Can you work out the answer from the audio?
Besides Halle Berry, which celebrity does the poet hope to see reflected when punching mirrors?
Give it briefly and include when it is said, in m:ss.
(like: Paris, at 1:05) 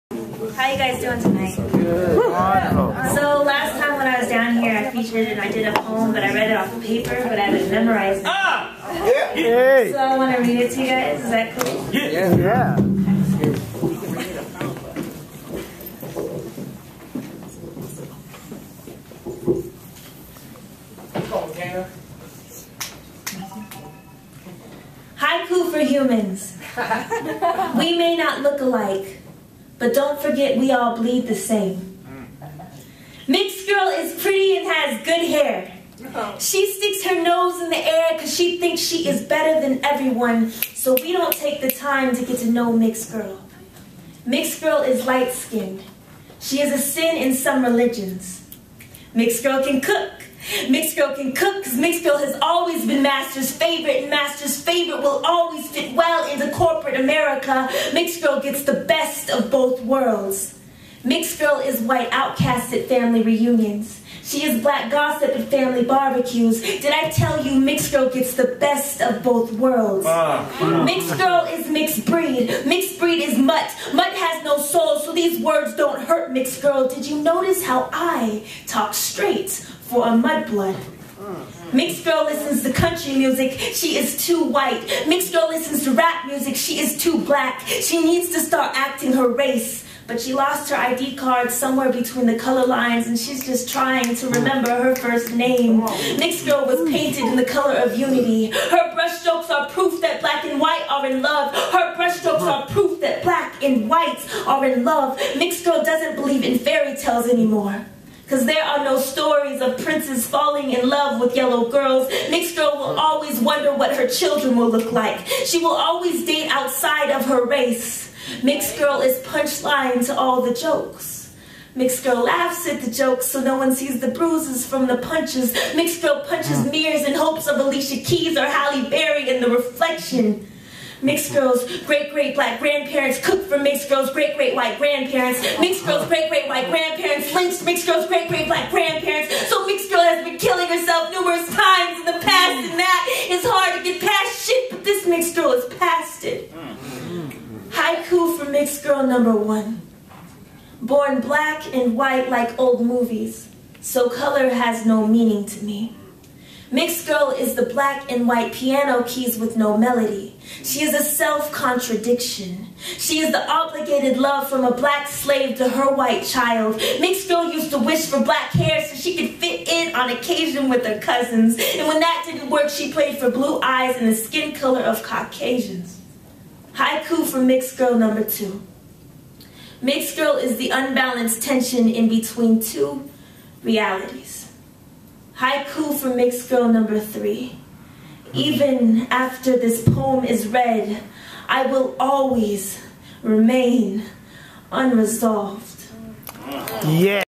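Alicia Keys, at 2:07.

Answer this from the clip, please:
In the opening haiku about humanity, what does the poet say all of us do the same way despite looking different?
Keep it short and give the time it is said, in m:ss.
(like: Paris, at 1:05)
bleed, at 0:30.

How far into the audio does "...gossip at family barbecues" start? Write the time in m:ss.
1:04.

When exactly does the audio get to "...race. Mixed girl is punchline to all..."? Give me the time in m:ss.
1:57.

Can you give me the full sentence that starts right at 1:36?
Mixed girl was painted in the color of unity.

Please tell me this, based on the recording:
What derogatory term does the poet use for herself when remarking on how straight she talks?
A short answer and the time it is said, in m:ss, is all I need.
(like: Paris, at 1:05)
mudblood, at 1:20.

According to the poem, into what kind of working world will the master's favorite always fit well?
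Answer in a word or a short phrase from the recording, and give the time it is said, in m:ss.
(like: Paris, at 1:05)
corporate America, at 0:56.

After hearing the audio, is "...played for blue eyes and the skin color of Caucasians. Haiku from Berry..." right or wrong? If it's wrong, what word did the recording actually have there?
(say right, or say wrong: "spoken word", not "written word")
wrong: "Mixed", not "Berry".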